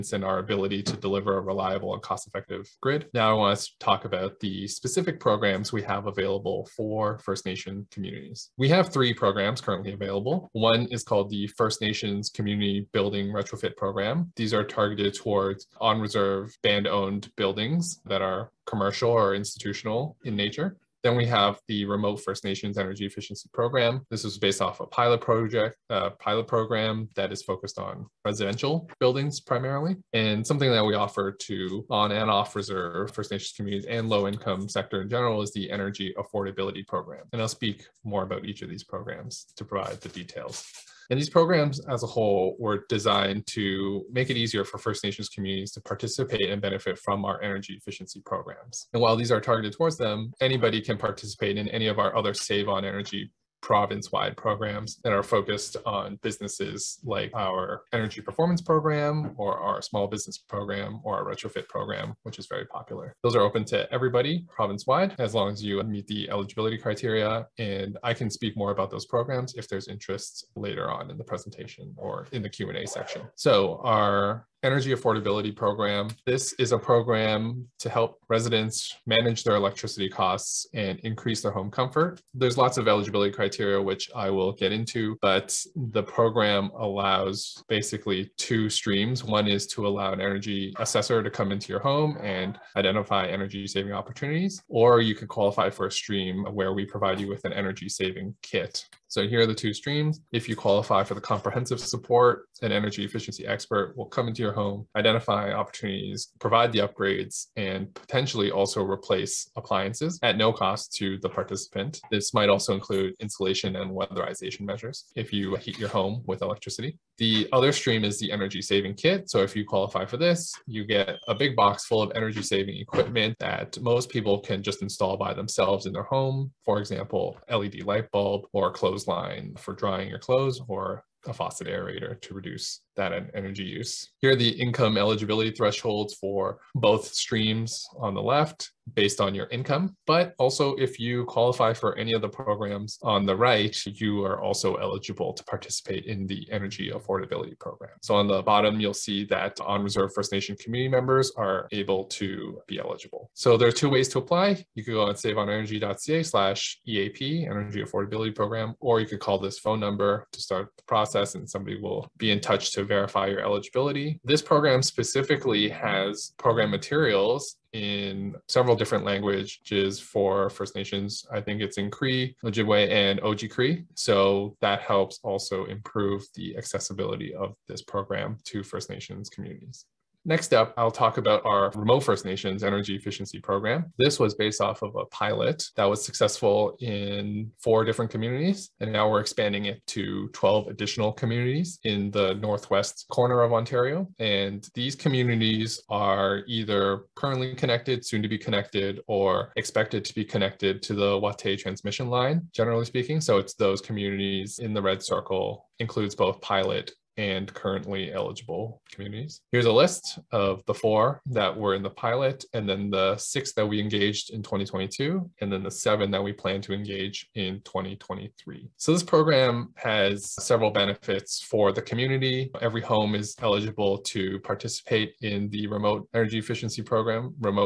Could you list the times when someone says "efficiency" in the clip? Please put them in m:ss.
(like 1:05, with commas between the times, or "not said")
0:23, 0:47, 1:43, 3:02, 3:46.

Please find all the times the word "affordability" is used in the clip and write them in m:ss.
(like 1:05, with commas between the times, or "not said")
0:36, 1:14, 2:26, 2:37.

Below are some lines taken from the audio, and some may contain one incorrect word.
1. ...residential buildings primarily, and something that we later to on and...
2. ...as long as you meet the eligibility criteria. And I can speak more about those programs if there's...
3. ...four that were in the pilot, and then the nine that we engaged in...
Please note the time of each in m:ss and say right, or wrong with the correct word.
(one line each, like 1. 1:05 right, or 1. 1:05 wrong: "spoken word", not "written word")
1. 0:28 wrong: "offer", not "later"
2. 1:05 right
3. 3:30 wrong: "six", not "nine".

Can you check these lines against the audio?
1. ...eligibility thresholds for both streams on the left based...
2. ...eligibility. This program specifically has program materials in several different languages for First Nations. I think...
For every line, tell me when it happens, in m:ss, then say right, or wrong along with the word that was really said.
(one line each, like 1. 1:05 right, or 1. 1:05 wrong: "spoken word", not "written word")
1. 2:14 right
2. 2:43 right.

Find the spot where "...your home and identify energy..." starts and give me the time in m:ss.
1:31.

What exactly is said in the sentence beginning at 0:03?
Now I want to talk about the specific programs we have available for First Nation communities.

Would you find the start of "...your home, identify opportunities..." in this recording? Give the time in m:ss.
1:44.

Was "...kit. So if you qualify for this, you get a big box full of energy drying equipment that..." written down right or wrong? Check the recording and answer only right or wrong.
wrong.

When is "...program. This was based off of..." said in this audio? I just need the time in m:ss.
3:03.